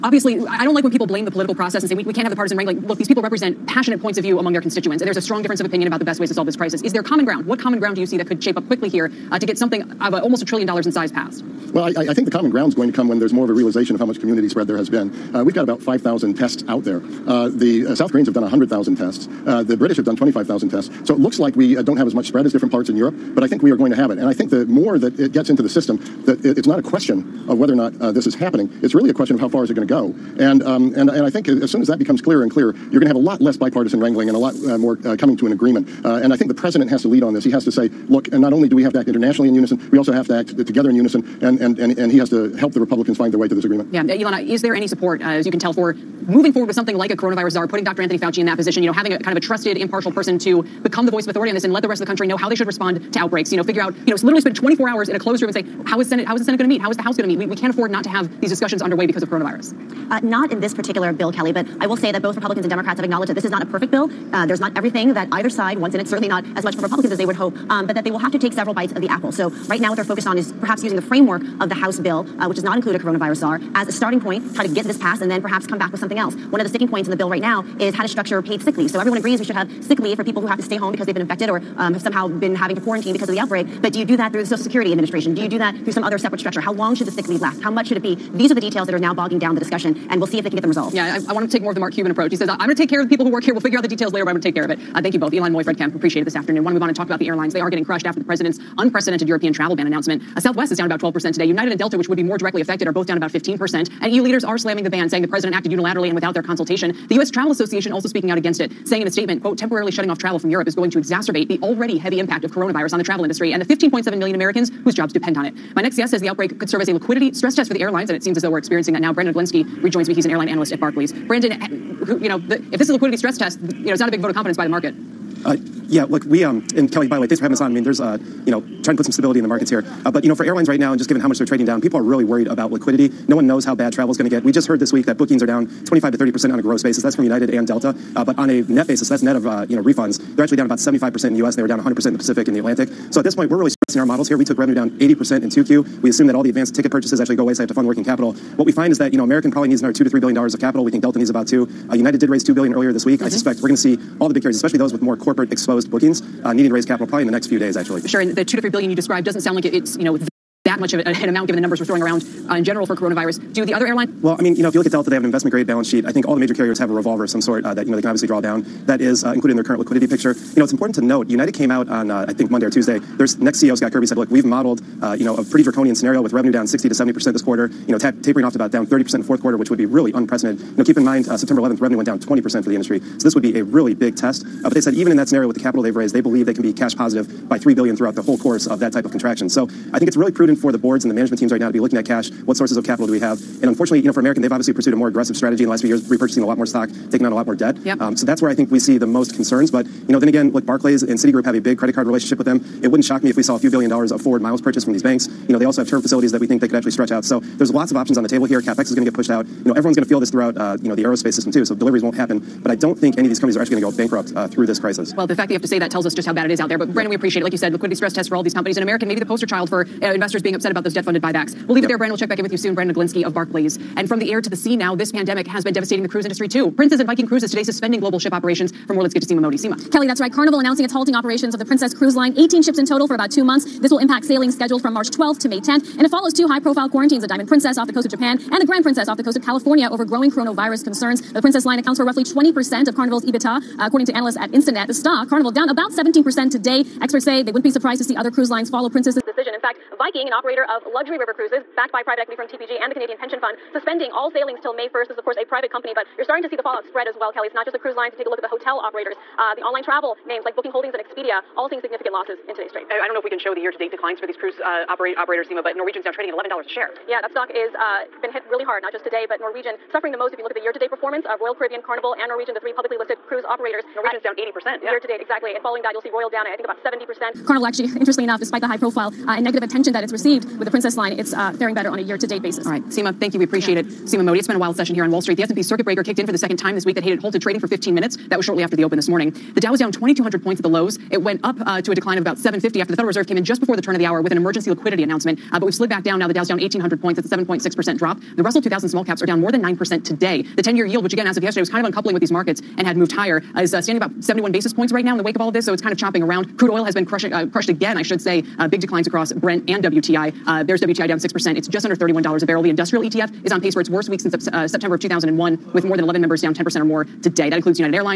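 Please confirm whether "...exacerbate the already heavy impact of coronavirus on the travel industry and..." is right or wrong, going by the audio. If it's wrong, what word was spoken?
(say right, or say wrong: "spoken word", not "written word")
right.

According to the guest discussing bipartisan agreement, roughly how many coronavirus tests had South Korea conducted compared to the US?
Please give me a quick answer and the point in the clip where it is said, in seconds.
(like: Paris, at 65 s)
100,000, at 18 s.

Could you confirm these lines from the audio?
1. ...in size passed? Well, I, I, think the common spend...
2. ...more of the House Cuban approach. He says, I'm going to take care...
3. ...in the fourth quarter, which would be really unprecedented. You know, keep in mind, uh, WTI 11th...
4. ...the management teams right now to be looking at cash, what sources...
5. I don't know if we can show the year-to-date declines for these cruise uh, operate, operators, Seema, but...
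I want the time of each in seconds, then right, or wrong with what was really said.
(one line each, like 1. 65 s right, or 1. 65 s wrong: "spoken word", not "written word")
1. 10 s wrong: "ground", not "spend"
2. 91 s wrong: "Mark", not "House"
3. 179 s wrong: "September", not "WTI"
4. 191 s right
5. 262 s right.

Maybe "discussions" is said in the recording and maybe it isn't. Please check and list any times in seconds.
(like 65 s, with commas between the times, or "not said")
58 s, 89 s.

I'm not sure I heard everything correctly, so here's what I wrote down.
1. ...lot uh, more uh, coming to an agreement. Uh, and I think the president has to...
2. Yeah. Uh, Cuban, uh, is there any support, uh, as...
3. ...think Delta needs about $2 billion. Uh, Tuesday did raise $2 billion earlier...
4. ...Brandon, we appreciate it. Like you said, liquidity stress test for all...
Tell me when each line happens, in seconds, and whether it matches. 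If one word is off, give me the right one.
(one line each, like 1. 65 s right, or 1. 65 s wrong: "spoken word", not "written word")
1. 34 s right
2. 43 s wrong: "Ylan", not "Cuban"
3. 150 s wrong: "United", not "Tuesday"
4. 216 s right.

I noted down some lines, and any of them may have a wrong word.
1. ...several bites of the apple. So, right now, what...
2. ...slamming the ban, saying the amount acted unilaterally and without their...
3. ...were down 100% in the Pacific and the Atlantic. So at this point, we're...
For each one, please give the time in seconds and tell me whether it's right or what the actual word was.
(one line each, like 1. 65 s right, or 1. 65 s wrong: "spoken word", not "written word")
1. 68 s right
2. 104 s wrong: "president", not "amount"
3. 141 s right.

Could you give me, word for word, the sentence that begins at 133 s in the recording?
No one knows how bad travel is going to get.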